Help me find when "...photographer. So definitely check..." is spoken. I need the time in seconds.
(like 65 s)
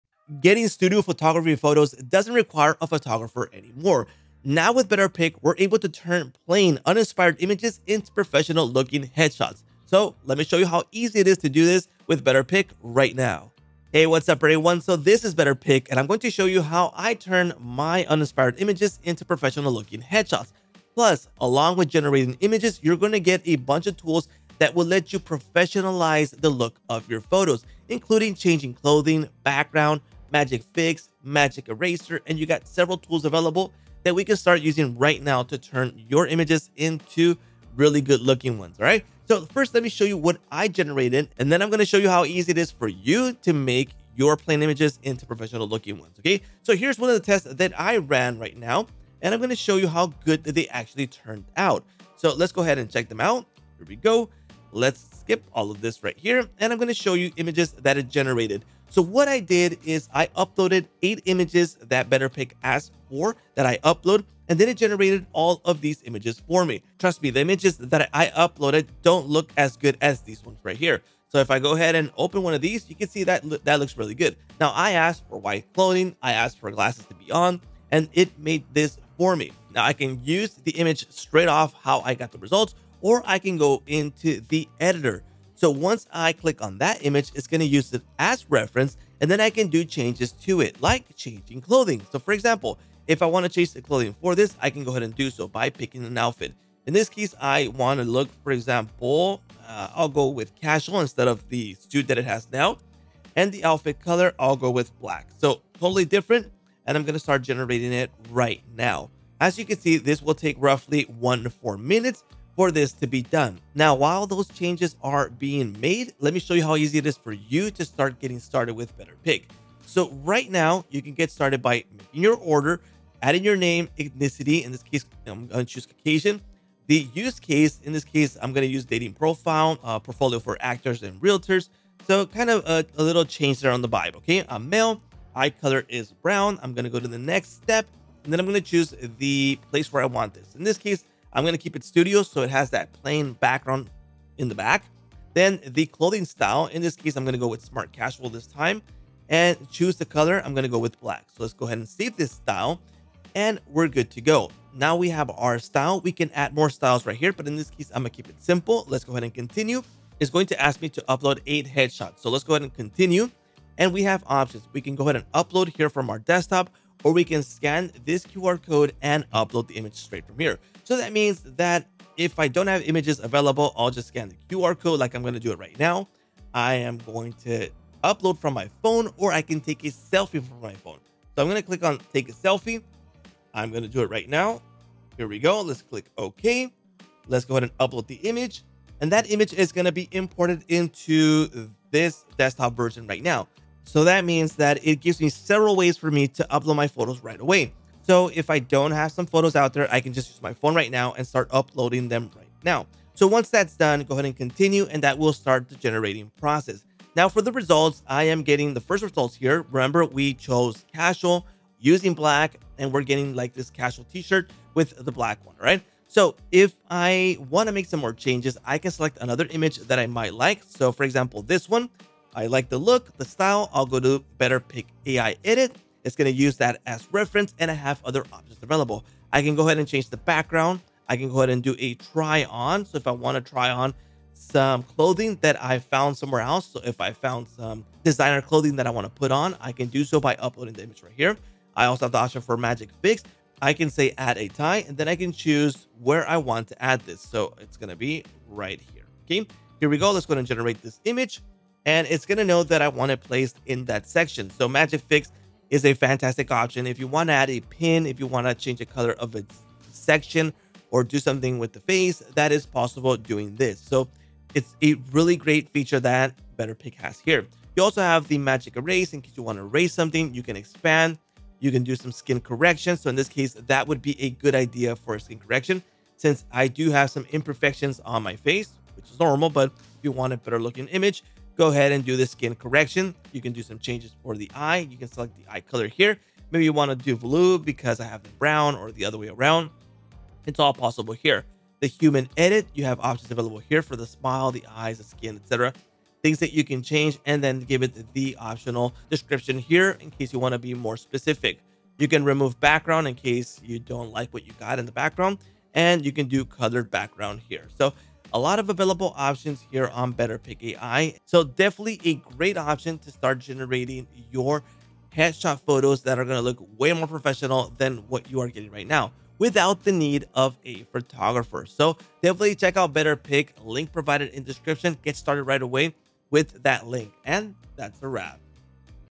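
320 s.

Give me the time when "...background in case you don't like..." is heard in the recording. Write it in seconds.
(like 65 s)
302 s.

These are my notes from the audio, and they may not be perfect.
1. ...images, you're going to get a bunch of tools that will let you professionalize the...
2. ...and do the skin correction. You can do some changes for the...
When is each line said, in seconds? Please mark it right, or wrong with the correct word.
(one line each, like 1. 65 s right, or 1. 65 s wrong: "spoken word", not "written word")
1. 22 s right
2. 281 s right.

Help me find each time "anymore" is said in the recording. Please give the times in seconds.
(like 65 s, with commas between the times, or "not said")
3 s.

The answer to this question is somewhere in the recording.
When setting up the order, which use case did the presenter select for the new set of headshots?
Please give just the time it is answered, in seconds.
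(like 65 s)
128 s.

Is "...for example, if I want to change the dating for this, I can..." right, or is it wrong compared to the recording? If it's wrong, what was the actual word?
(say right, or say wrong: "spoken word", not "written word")
wrong: "clothing", not "dating".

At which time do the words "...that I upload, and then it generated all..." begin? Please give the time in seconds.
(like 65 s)
63 s.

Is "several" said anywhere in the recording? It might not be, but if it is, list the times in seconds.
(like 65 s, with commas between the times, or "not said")
32 s, 195 s.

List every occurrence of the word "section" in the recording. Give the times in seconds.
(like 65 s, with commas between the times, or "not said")
254 s, 259 s.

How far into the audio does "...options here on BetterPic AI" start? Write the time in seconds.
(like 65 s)
309 s.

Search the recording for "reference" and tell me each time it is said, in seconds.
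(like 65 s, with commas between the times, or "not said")
88 s, 227 s.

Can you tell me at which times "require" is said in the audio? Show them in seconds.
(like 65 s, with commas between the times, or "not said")
2 s.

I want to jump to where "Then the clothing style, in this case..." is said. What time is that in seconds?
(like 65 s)
145 s.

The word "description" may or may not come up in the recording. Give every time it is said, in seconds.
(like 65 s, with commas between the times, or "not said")
299 s, 324 s.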